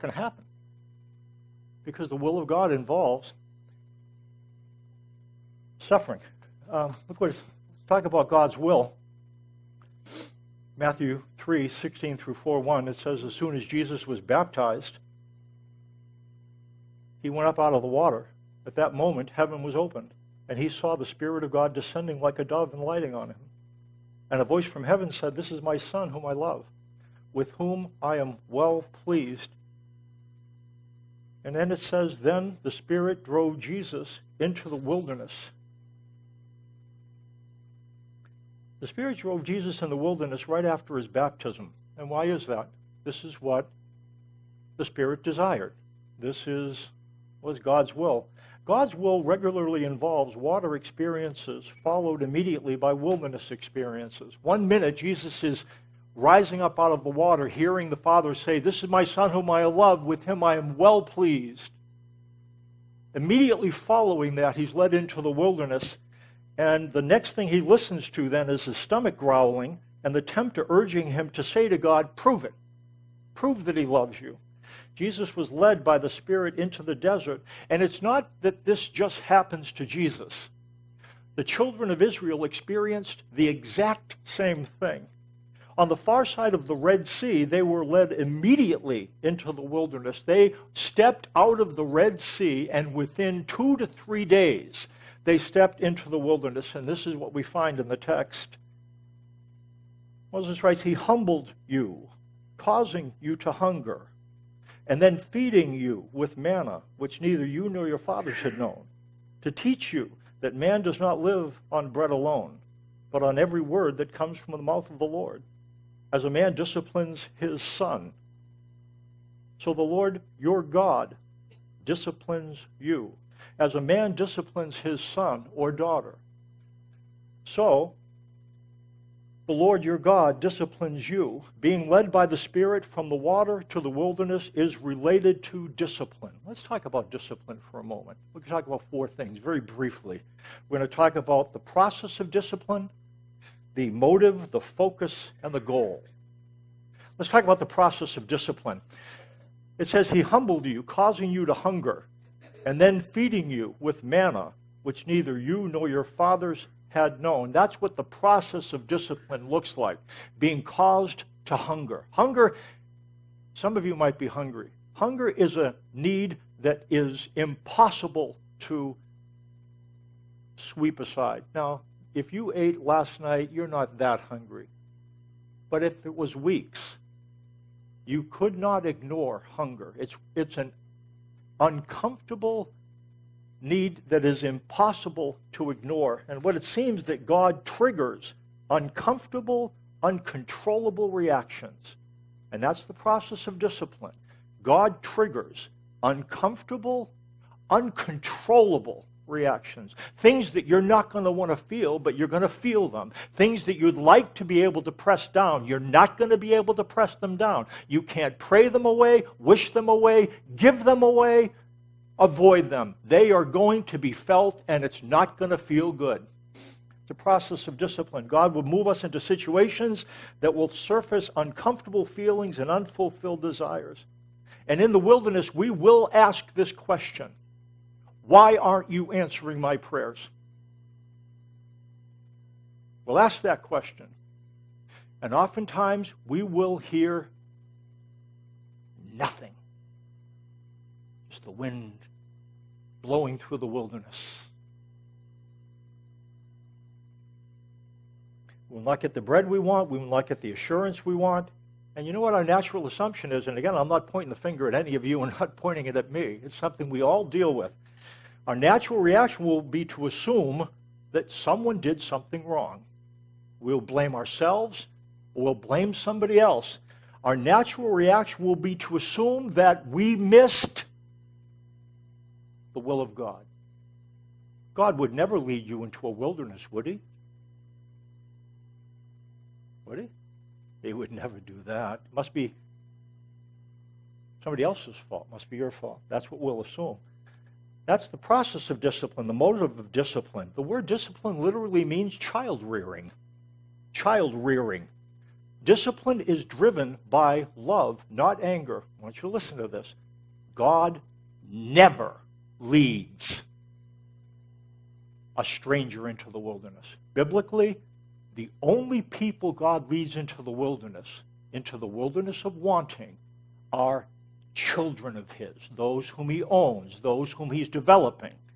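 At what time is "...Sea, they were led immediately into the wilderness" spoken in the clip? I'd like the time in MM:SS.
01:27.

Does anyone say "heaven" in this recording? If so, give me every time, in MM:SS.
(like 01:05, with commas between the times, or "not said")
00:19, 00:24.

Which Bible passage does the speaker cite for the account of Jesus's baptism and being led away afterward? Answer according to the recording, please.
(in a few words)
Matthew 3:16 through 4:1.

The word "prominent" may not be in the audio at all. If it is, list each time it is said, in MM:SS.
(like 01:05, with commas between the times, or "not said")
not said.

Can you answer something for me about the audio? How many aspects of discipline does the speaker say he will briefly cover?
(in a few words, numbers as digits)
4.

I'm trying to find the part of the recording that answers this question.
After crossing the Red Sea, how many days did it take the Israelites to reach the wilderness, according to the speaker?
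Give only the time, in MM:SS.
01:33.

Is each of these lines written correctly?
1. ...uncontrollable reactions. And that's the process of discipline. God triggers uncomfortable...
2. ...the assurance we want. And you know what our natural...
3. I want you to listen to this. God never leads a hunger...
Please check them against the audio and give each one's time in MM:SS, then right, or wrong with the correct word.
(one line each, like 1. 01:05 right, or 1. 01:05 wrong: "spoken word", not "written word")
1. 03:10 right
2. 04:10 right
3. 04:58 wrong: "stranger", not "hunger".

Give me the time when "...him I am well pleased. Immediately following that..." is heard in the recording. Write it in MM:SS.
01:00.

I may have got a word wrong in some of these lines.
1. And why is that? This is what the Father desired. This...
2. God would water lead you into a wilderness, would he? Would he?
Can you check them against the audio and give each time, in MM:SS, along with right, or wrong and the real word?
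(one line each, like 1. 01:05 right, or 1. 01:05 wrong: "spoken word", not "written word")
1. 00:41 wrong: "Spirit", not "Father"
2. 04:34 wrong: "never", not "water".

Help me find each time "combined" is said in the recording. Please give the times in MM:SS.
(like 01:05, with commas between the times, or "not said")
not said.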